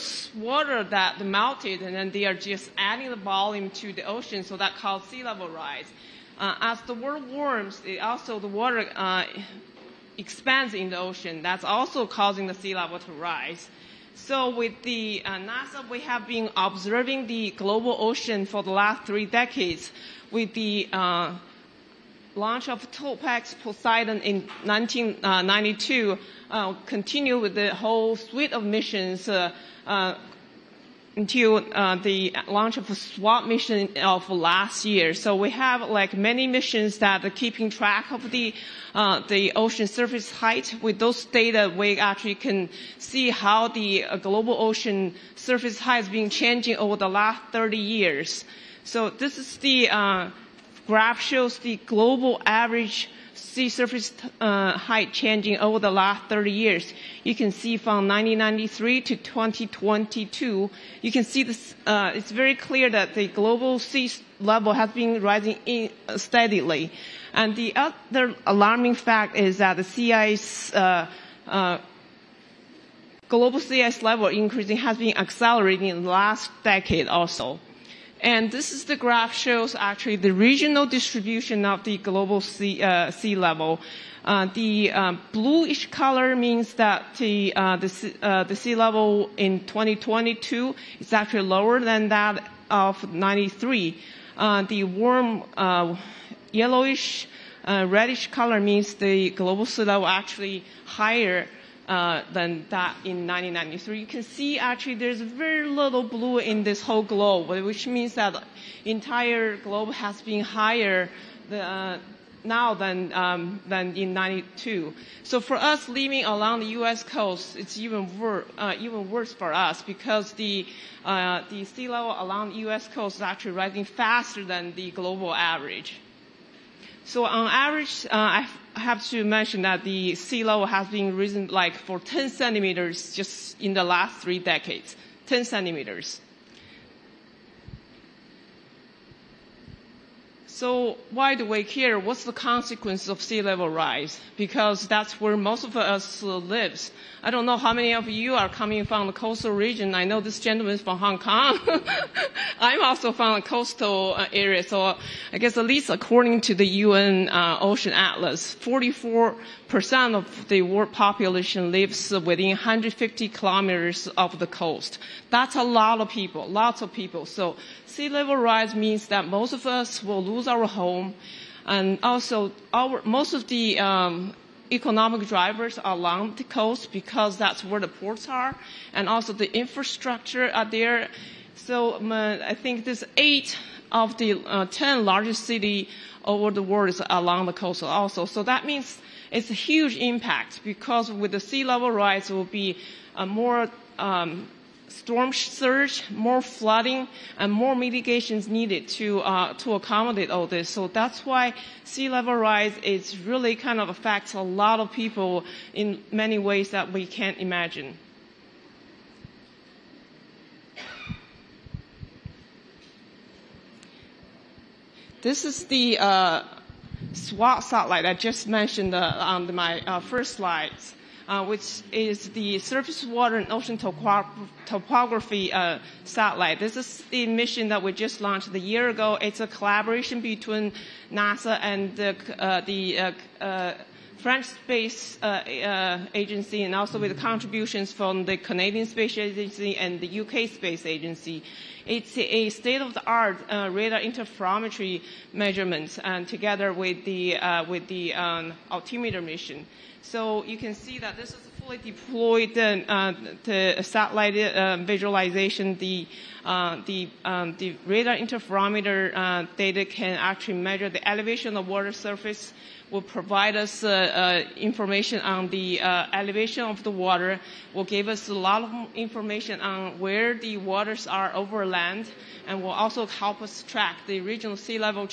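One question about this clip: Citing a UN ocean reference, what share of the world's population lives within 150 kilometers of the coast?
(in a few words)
44%.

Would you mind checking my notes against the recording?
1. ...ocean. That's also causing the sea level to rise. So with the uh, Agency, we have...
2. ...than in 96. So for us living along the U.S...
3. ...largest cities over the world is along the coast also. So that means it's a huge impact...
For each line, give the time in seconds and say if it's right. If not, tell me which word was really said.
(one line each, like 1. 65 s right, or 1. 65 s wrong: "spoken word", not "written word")
1. 10 s wrong: "NASA", not "Agency"
2. 113 s wrong: "92", not "96"
3. 185 s right.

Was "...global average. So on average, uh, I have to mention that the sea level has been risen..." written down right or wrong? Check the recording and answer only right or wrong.
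right.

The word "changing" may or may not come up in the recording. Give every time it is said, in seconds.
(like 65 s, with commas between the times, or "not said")
46 s, 55 s.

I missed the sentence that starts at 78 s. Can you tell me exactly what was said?
And this is the graph shows actually the regional distribution of the global sea, uh, sea level.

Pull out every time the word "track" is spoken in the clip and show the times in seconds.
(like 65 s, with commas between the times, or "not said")
37 s, 273 s.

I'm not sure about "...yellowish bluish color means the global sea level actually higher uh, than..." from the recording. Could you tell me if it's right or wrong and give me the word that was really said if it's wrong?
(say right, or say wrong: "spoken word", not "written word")
wrong: "reddish", not "bluish".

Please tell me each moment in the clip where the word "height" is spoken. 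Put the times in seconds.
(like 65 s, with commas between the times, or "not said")
40 s, 45 s, 54 s.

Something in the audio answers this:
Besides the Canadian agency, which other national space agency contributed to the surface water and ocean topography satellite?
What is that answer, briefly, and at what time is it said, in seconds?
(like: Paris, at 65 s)
UK Space Agency, at 240 s.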